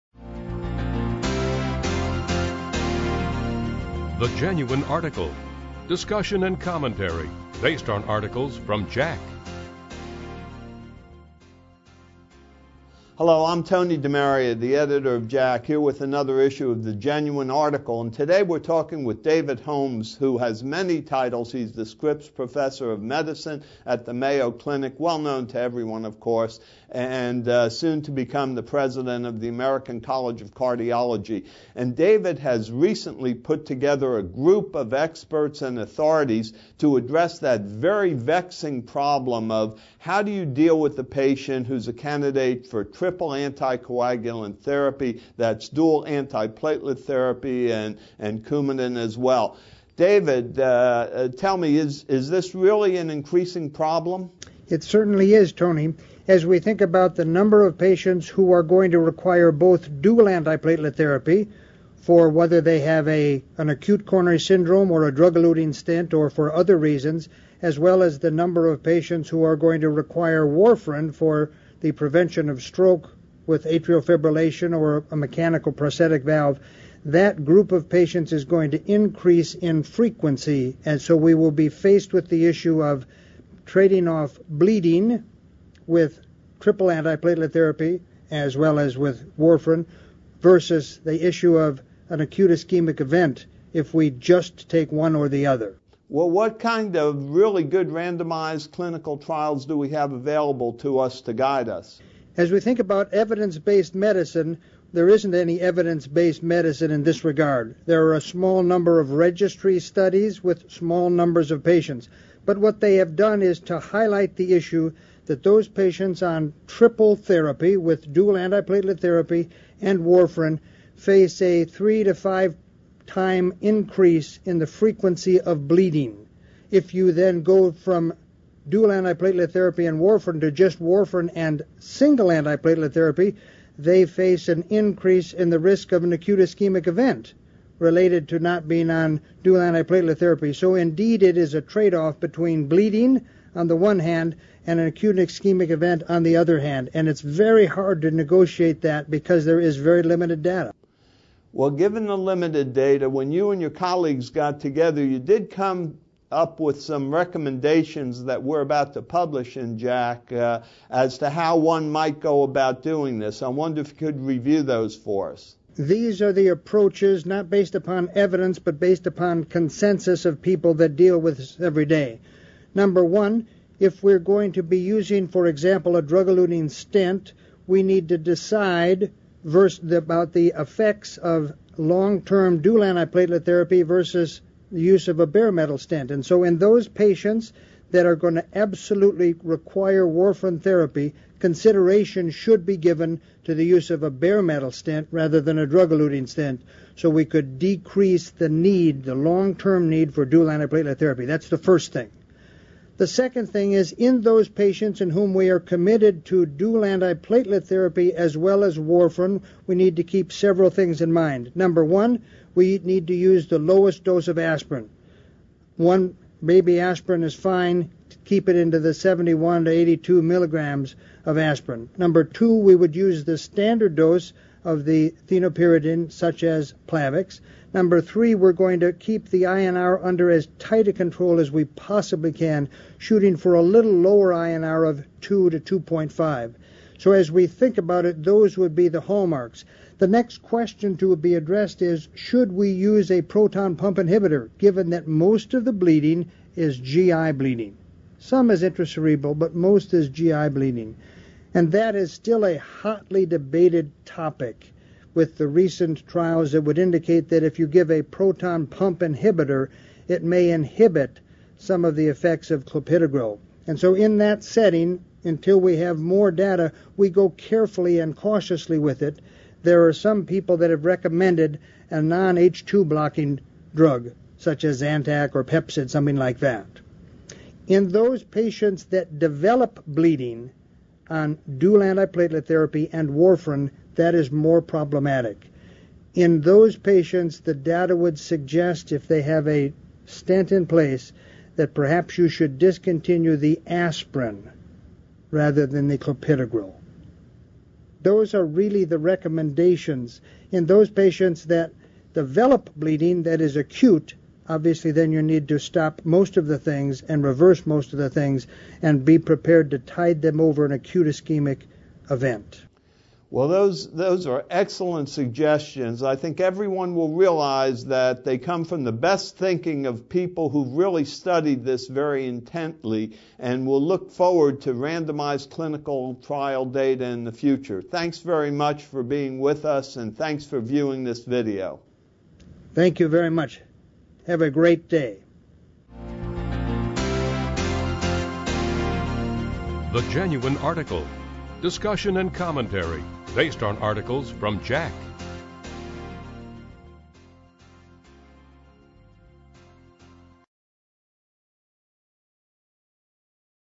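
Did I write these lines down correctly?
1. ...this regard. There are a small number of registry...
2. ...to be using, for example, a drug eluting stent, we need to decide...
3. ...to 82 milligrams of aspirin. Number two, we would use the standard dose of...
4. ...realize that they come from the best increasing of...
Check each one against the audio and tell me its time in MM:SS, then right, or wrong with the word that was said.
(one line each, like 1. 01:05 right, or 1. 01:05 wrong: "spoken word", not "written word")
1. 01:47 right
2. 02:54 right
3. 03:39 right
4. 05:17 wrong: "thinking", not "increasing".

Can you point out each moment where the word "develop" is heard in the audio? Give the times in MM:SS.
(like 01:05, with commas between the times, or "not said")
04:39, 05:02.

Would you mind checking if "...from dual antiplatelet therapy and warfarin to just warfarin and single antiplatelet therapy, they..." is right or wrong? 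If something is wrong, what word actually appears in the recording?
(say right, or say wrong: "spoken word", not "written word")
right.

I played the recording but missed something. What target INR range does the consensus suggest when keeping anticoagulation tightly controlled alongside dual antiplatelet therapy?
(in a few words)
2 to 2.5.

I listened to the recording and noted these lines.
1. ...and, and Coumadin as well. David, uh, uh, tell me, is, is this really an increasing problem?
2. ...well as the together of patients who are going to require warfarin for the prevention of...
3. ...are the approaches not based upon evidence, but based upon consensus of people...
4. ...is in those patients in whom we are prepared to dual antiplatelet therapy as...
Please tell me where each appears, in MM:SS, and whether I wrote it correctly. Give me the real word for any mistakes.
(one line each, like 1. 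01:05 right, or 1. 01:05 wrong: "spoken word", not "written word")
1. 00:47 right
2. 01:07 wrong: "number", not "together"
3. 02:46 right
4. 03:23 wrong: "committed", not "prepared".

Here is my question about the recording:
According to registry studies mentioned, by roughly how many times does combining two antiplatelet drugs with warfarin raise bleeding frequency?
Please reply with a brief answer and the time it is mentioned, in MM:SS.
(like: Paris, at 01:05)
3 to 5, at 02:01.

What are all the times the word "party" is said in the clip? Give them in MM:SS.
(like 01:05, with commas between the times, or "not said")
not said.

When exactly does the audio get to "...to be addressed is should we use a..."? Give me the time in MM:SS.
04:00.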